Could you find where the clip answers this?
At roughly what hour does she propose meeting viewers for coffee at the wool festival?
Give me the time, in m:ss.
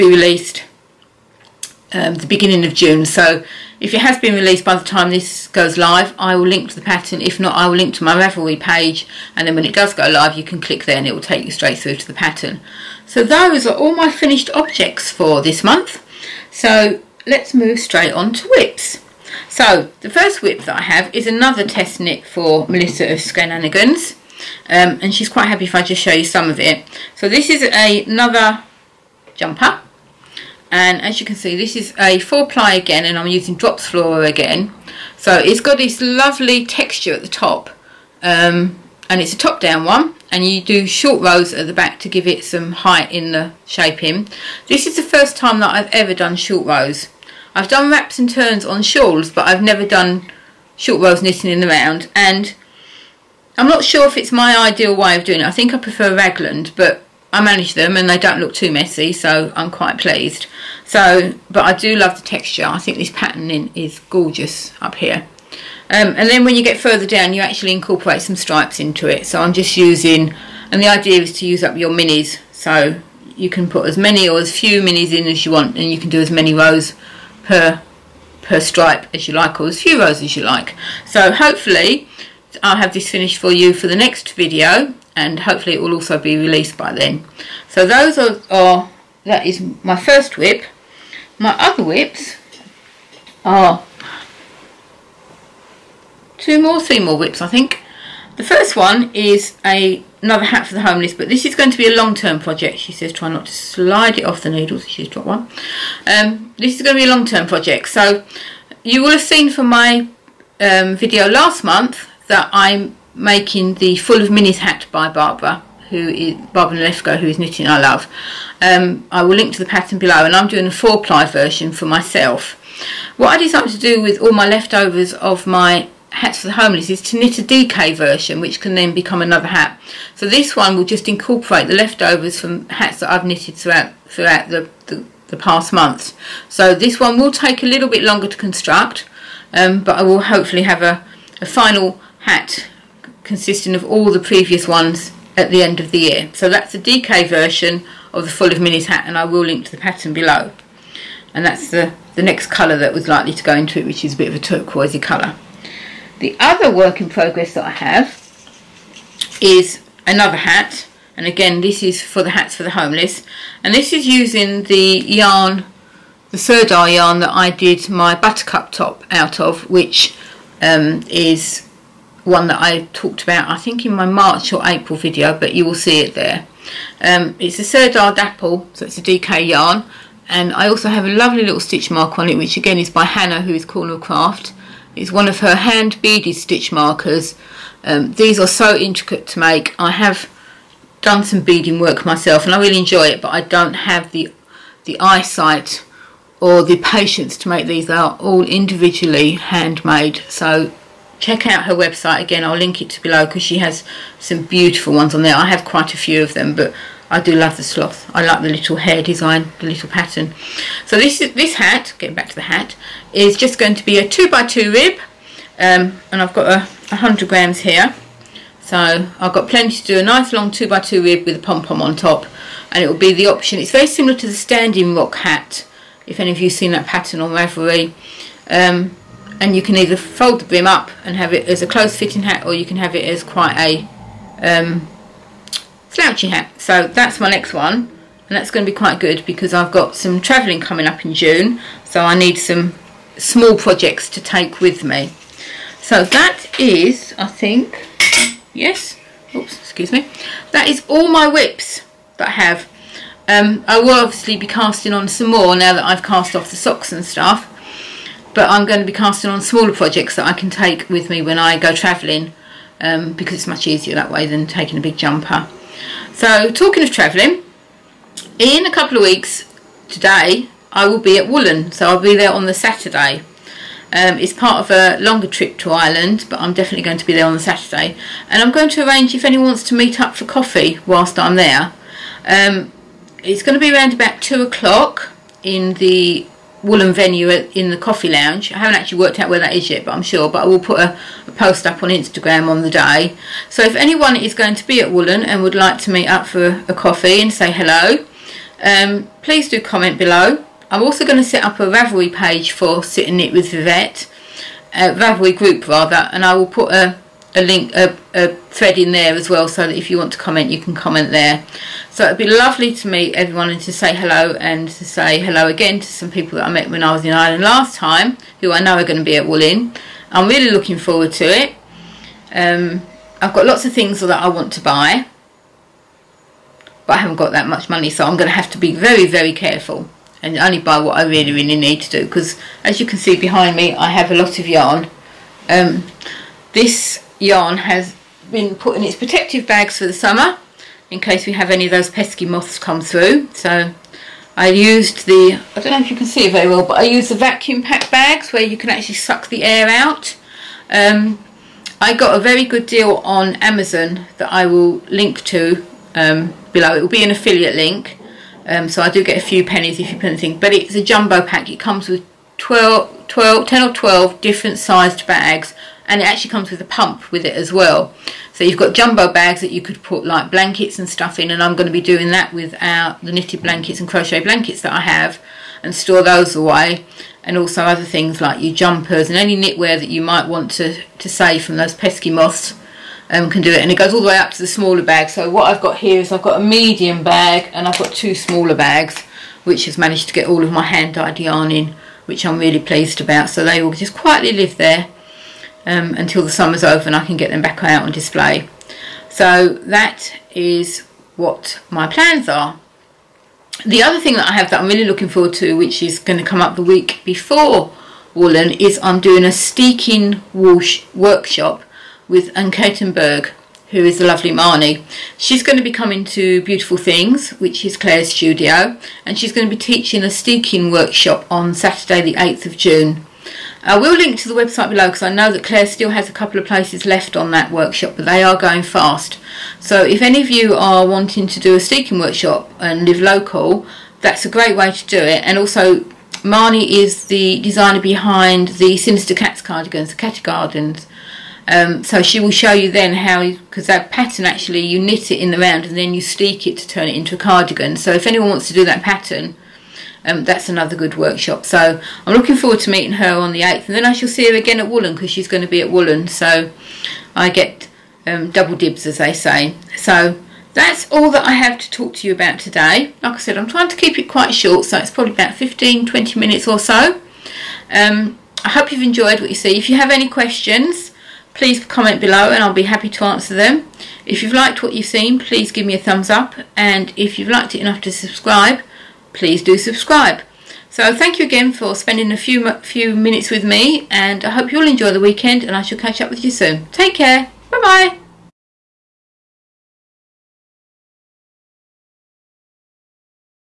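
4:44.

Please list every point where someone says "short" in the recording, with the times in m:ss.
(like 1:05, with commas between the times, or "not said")
0:40, 0:46, 0:50, 7:44.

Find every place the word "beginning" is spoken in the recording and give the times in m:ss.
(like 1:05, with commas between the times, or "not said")
0:02.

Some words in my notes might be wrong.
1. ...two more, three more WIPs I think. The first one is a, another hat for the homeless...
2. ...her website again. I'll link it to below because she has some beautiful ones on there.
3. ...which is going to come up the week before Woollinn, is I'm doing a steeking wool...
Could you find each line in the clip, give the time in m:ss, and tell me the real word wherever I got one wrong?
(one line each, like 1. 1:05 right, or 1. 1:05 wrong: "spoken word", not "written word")
1. 1:36 right
2. 3:21 right
3. 6:45 right.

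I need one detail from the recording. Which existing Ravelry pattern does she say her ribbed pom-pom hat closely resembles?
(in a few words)
Standing Rock hat.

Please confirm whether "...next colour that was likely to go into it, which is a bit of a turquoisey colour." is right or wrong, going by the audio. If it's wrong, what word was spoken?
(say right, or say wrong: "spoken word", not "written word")
right.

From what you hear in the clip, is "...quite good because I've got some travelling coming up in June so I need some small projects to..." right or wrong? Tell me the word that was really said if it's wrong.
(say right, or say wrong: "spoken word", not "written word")
right.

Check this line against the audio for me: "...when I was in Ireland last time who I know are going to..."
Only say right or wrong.
right.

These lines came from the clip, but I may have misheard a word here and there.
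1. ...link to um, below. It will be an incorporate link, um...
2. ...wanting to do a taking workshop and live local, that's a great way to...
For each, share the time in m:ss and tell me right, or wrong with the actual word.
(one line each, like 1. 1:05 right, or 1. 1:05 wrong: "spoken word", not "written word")
1. 5:54 wrong: "affiliate", not "incorporate"
2. 7:10 wrong: "steeking", not "taking".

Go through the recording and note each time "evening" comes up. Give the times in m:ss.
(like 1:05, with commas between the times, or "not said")
not said.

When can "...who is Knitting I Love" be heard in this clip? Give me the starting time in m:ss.
1:57.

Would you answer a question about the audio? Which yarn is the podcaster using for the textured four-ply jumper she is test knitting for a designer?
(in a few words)
Drops Flora.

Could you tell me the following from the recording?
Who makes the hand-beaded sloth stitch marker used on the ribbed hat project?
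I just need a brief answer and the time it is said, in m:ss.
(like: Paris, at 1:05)
Cornercraft, at 3:03.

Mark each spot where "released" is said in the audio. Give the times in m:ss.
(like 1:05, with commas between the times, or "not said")
0:00, 0:04, 1:26.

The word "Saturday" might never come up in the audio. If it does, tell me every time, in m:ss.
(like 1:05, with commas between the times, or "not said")
4:32, 4:37, 7:01.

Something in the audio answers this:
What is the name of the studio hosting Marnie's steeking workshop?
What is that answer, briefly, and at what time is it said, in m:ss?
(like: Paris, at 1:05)
Beautiful Things, at 6:56.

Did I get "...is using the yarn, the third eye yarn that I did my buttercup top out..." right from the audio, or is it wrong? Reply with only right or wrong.
right.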